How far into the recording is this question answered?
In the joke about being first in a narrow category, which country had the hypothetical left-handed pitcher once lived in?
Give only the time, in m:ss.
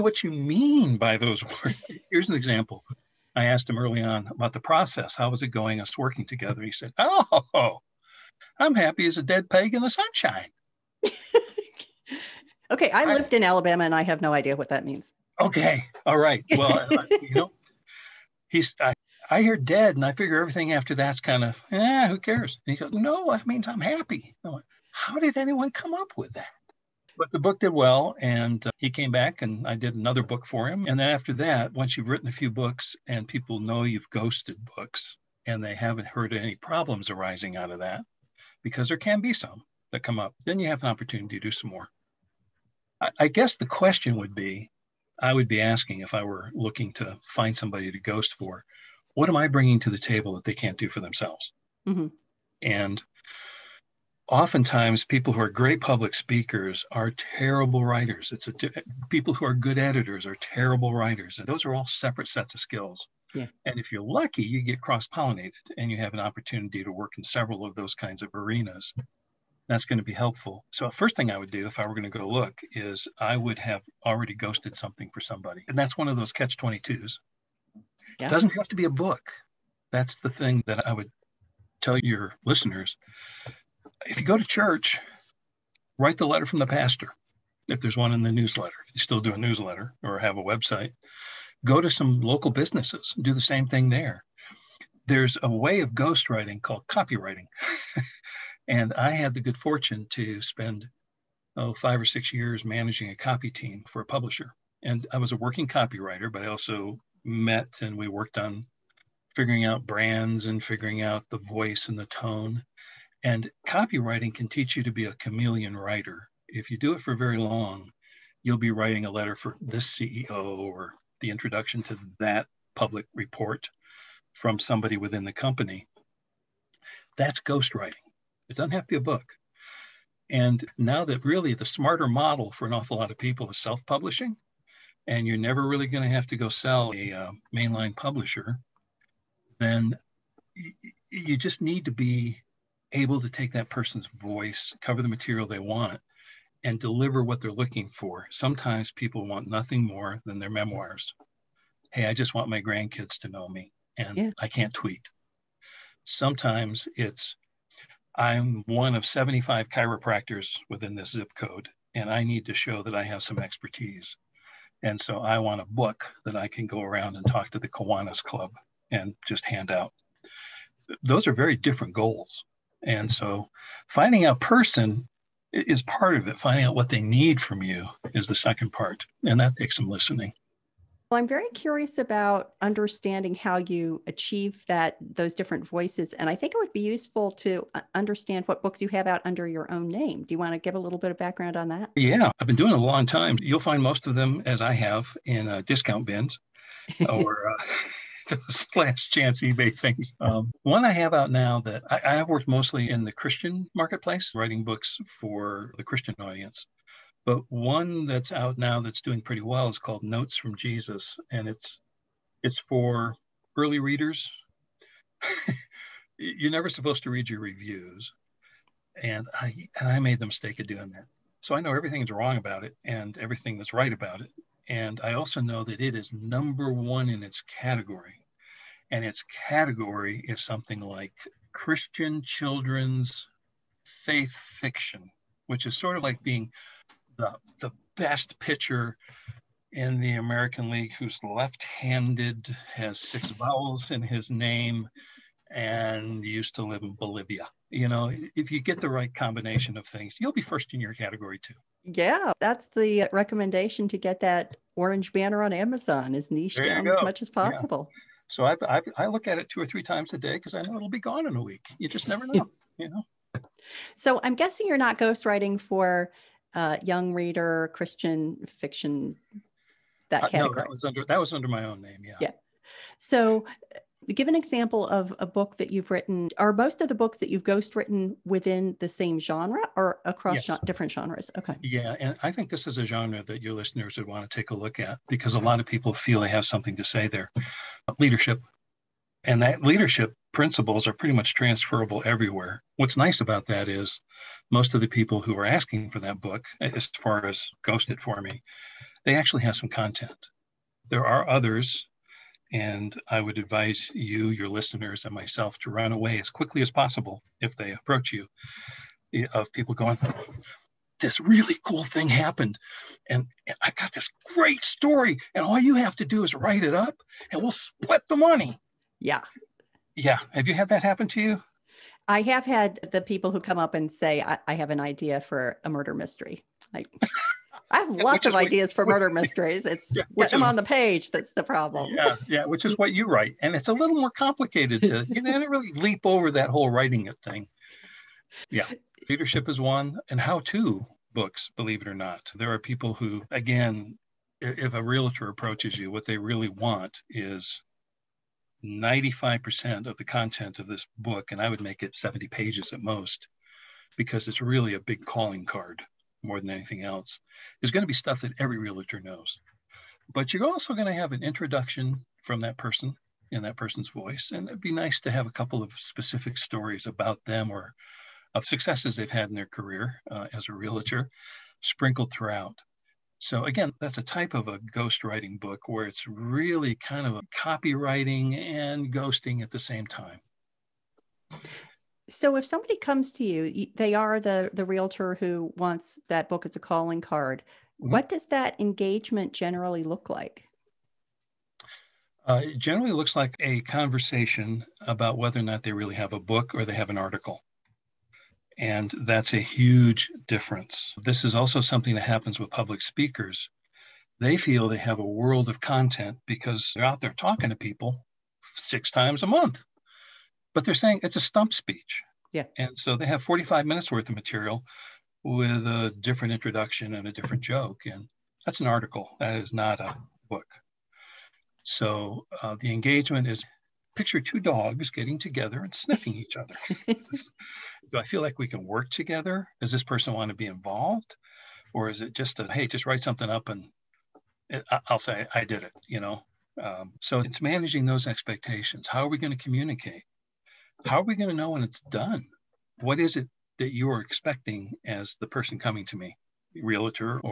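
4:06.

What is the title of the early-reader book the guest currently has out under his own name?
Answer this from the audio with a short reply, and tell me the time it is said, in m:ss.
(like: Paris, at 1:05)
Notes from Jesus, at 3:30.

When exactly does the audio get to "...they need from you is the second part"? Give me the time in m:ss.
2:56.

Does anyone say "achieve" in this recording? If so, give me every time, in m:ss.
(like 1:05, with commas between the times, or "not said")
3:04.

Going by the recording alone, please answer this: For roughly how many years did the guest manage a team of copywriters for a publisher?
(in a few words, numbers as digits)
5 or 6 years.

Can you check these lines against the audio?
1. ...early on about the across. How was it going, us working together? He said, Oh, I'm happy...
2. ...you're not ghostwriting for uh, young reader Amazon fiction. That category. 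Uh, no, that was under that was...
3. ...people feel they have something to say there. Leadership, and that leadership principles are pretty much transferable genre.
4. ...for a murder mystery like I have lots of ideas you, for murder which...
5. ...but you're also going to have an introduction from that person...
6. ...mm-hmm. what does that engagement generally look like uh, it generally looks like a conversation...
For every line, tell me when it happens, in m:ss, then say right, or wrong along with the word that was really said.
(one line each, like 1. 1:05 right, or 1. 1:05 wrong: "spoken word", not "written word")
1. 0:03 wrong: "process", not "across"
2. 4:24 wrong: "Christian", not "Amazon"
3. 4:45 wrong: "everywhere", not "genre"
4. 5:25 right
5. 6:00 right
6. 6:27 right.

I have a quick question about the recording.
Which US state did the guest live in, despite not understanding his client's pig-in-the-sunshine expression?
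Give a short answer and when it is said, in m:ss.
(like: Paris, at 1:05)
Alabama, at 0:13.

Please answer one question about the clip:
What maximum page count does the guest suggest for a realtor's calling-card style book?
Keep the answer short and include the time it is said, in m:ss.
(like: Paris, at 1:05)
70 pages, at 5:51.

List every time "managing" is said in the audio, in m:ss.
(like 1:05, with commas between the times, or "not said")
1:42, 7:17.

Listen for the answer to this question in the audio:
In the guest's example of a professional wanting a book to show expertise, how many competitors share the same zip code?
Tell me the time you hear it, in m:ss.
2:39.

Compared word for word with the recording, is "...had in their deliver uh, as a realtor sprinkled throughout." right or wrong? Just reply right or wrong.
wrong.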